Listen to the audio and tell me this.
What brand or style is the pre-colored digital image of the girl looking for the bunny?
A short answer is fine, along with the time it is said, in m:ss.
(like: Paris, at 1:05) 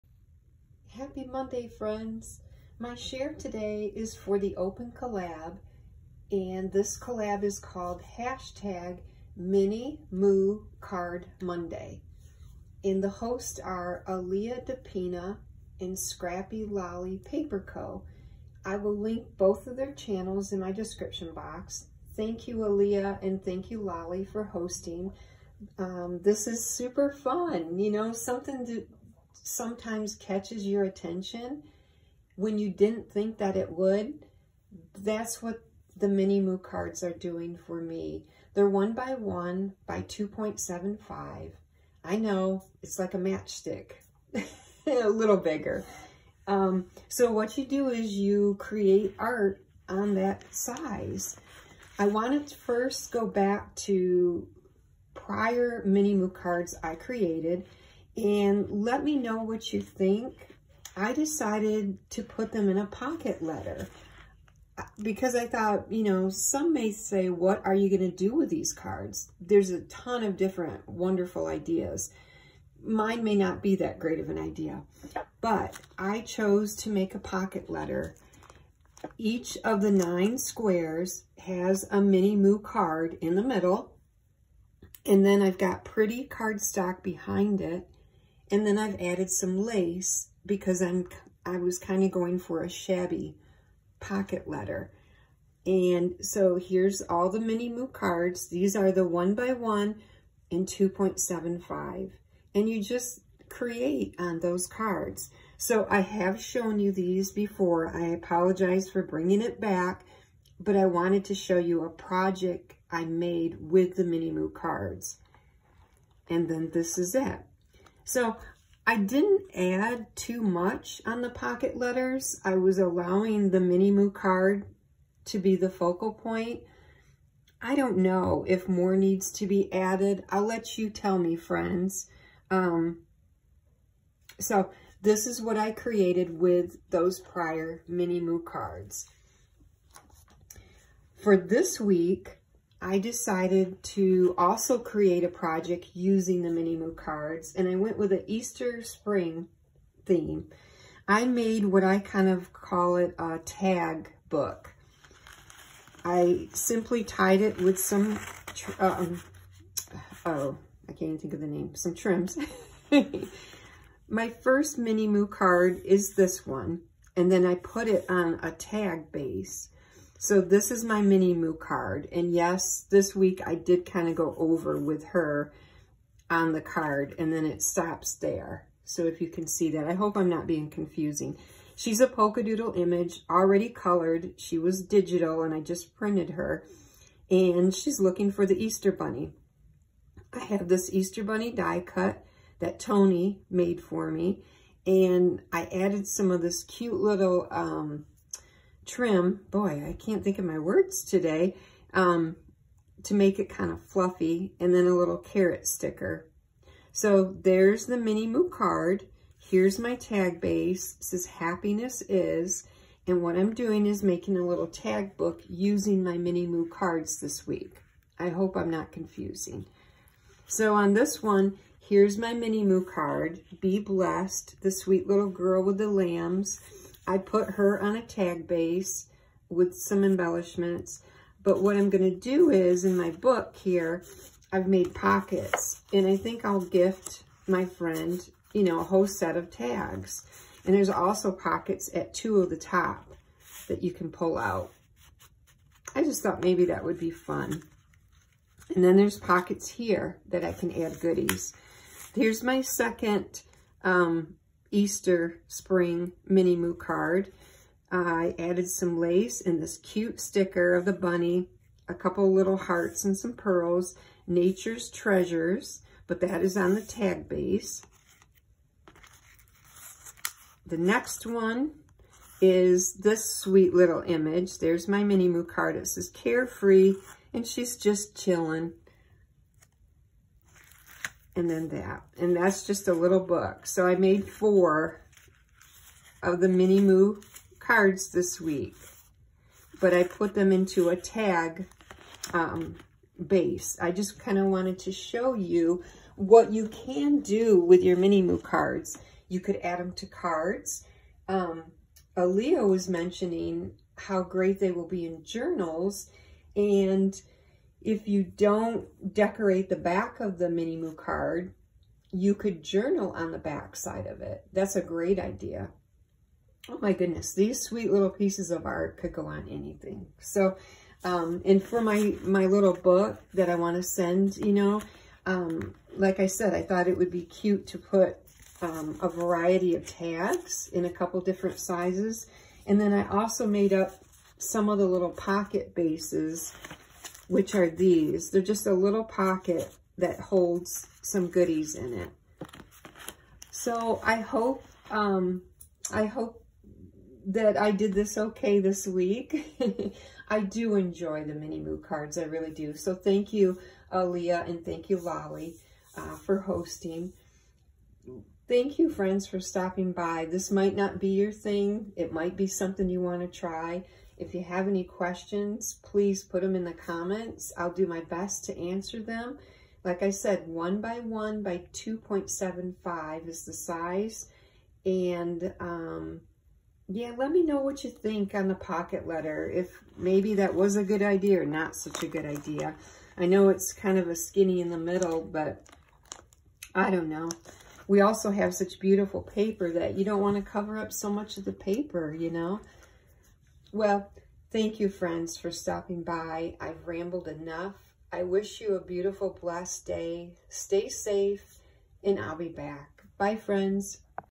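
polka doodle, at 3:02.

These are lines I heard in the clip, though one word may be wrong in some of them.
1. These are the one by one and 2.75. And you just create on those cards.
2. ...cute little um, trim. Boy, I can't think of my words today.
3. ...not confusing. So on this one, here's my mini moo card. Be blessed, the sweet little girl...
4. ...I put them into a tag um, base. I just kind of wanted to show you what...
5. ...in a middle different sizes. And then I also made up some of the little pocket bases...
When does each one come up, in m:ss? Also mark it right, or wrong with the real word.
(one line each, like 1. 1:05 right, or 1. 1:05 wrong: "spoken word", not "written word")
1. 1:38 right
2. 3:16 right
3. 3:38 right
4. 4:49 right
5. 5:30 wrong: "couple", not "middle".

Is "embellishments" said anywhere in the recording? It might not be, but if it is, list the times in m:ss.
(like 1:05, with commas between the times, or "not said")
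3:50.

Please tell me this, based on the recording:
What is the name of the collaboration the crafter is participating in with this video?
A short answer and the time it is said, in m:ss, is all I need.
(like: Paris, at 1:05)
Mini Moo Card Monday, at 0:09.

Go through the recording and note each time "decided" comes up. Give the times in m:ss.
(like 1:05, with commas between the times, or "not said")
1:01, 2:22.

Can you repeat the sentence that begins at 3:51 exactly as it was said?
But what I'm going to do is, in my book here, I've made pockets.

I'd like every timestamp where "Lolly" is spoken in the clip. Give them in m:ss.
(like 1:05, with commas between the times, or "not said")
0:16, 0:23, 5:54.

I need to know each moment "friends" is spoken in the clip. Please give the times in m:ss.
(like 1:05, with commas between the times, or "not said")
0:01, 2:11, 3:57, 5:58, 6:34, 6:43.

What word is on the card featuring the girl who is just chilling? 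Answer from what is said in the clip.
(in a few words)
carefree.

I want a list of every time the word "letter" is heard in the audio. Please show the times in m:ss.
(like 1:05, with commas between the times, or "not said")
1:03, 1:17, 1:34, 2:01, 6:19.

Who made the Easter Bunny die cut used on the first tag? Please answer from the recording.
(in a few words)
Tony.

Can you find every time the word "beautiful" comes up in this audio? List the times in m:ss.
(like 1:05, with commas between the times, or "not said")
6:28, 6:38.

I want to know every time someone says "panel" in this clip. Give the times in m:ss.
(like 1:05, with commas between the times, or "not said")
not said.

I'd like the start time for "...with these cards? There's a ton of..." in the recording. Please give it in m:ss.
1:08.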